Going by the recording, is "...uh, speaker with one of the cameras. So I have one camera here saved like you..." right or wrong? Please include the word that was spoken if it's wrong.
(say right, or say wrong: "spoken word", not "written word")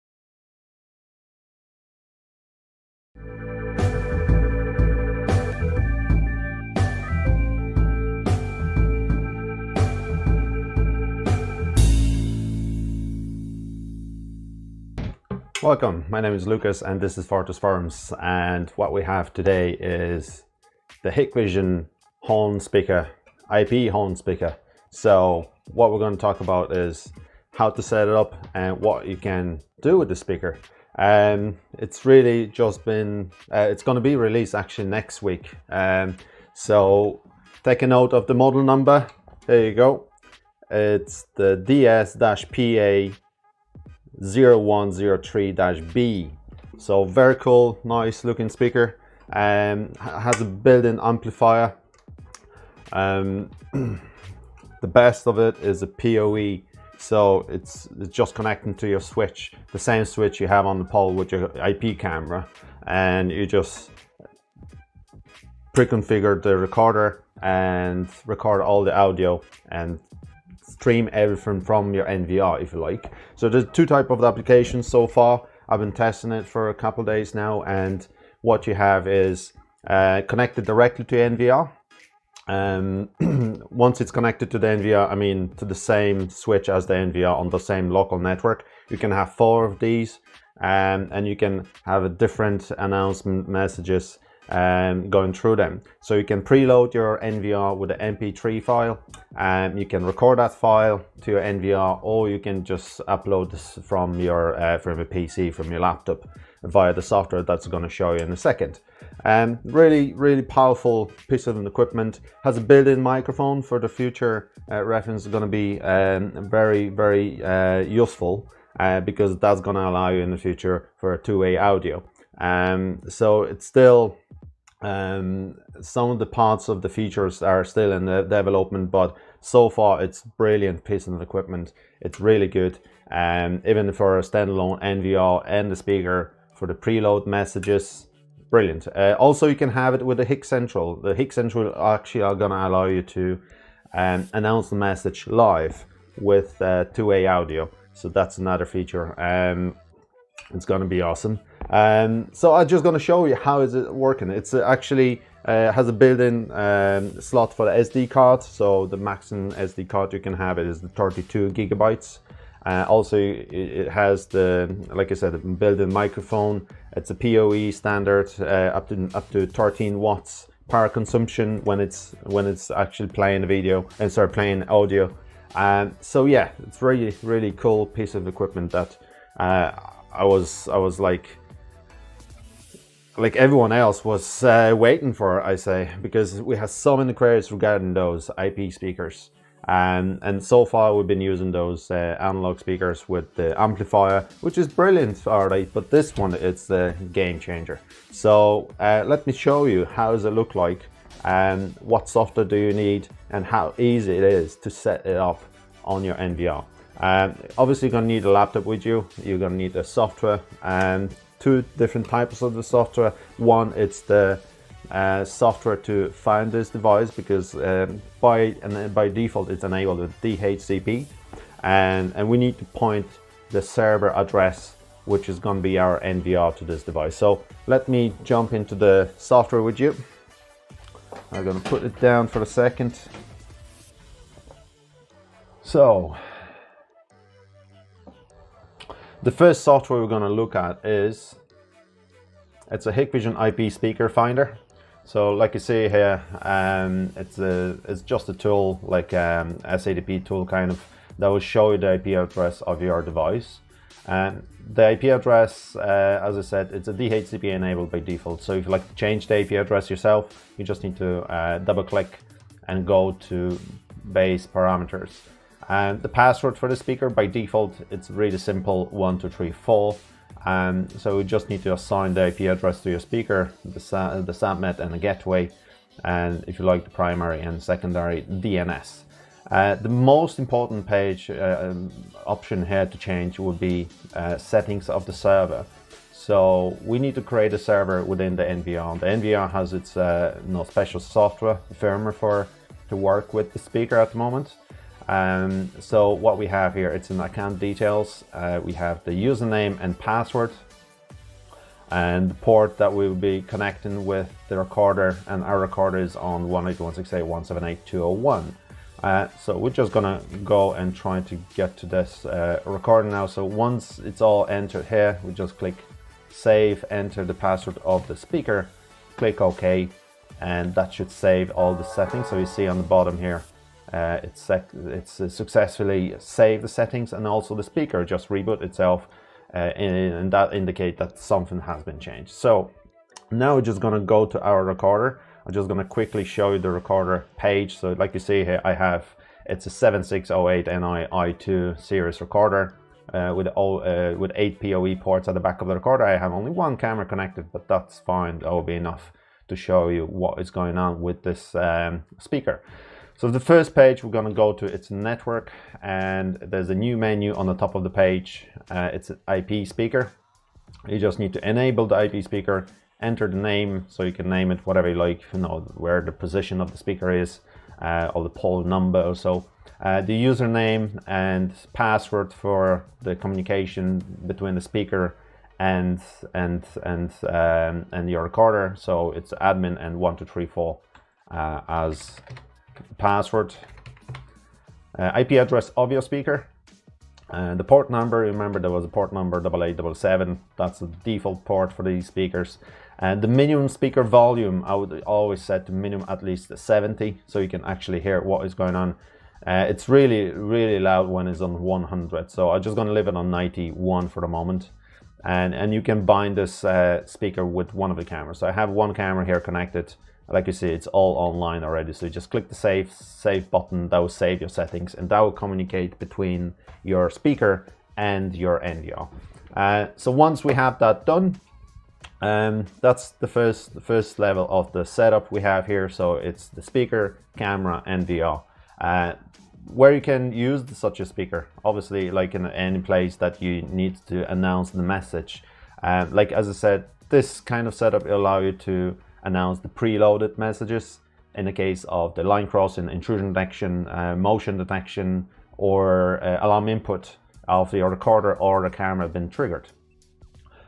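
wrong: "connected", not "saved".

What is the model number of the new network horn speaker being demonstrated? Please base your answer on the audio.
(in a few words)
DS-PA0103-B.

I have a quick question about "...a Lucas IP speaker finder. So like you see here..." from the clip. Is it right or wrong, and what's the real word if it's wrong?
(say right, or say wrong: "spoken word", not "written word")
wrong: "Hikvision", not "Lucas".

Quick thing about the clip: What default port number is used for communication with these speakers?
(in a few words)
8877.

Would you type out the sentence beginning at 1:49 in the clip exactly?
Um, really, really powerful piece of equipment.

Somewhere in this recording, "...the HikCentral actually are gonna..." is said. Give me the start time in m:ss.
2:21.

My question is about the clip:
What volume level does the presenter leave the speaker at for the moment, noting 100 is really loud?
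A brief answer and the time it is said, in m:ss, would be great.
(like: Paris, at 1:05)
91, at 6:43.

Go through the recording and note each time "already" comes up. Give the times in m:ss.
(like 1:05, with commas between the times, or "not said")
3:15, 6:51.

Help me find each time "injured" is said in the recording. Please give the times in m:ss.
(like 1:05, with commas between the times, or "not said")
not said.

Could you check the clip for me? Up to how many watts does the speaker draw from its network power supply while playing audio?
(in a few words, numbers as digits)
13 watts.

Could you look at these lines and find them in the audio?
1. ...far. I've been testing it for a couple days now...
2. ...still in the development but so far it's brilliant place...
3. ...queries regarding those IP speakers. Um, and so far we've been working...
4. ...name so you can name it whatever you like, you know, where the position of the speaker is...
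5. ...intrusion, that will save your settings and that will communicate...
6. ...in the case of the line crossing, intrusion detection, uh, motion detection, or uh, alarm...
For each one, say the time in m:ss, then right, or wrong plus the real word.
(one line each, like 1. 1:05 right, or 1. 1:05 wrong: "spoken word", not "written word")
1. 1:15 right
2. 2:07 wrong: "piece", not "place"
3. 3:07 wrong: "using", not "working"
4. 6:03 right
5. 6:53 wrong: "button", not "intrusion"
6. 7:21 right.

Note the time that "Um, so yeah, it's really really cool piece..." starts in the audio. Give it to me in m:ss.
2:55.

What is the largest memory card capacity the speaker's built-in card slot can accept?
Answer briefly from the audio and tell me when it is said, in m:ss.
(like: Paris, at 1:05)
32 GB, at 2:40.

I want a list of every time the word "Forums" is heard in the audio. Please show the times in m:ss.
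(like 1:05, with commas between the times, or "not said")
0:17.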